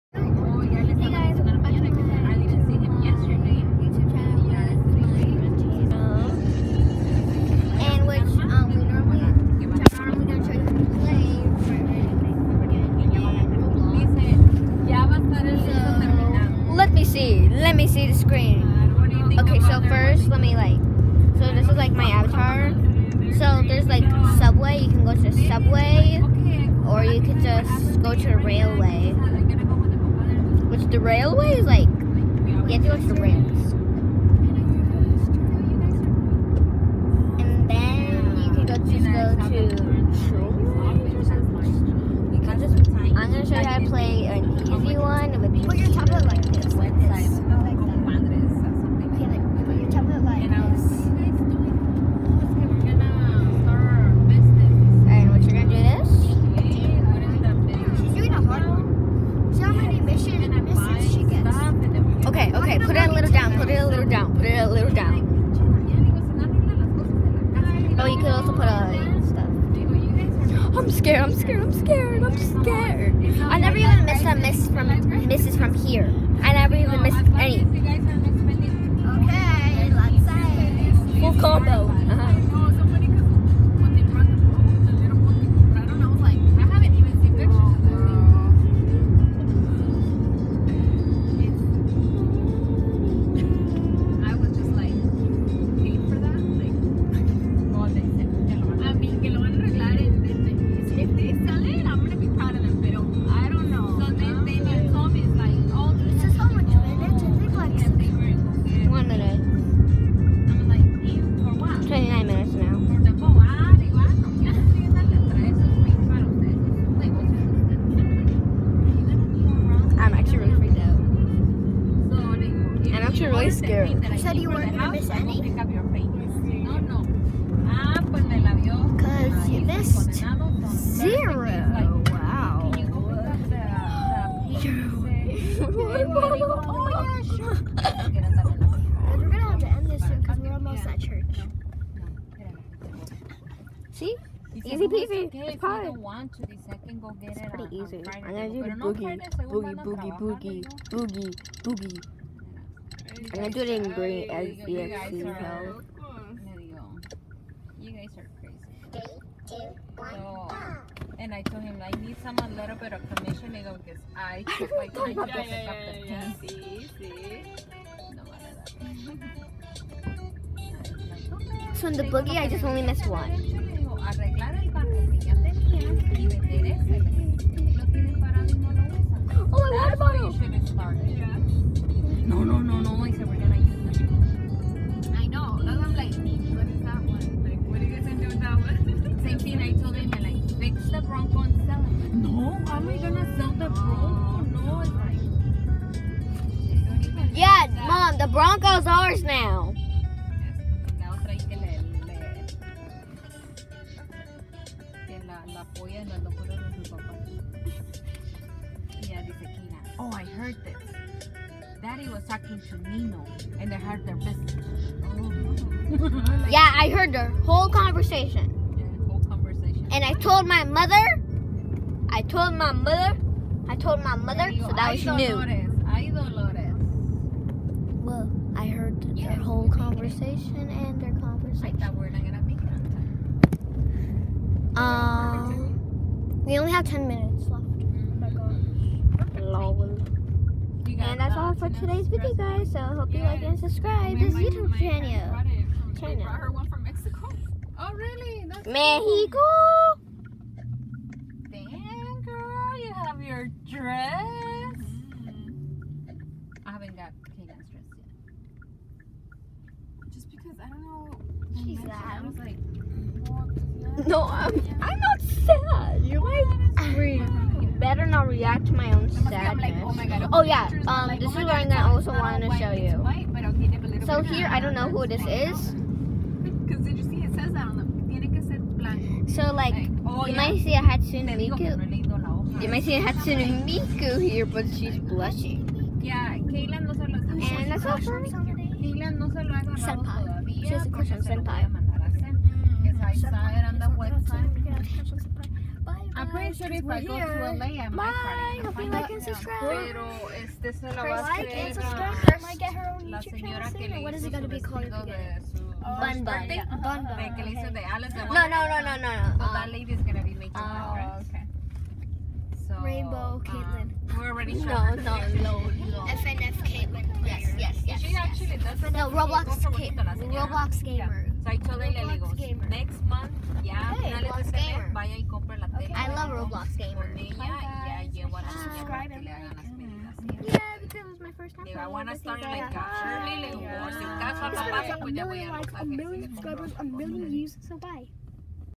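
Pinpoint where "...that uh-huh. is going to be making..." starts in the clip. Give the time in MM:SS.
05:09.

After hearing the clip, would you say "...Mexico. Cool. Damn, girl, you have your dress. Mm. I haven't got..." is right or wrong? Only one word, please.
right.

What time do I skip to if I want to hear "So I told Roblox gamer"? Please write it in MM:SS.
05:21.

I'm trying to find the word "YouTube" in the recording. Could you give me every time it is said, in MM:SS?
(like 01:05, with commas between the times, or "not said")
04:04, 05:03.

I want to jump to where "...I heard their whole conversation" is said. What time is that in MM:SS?
03:36.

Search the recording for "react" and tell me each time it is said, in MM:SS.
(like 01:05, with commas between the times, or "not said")
04:28.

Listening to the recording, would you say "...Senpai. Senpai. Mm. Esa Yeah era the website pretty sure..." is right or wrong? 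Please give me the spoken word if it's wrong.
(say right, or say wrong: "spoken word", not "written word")
wrong: "Isa", not "Yeah".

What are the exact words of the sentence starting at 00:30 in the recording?
Which the railway is like, you have to go to the rails.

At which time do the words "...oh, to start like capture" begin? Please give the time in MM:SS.
05:32.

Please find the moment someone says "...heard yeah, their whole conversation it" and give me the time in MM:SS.
03:48.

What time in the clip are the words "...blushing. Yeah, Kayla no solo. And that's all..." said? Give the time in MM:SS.
04:44.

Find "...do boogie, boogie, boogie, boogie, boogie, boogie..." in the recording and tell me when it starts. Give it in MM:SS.
02:28.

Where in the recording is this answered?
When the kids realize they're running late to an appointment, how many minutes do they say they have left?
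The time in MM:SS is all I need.
03:56.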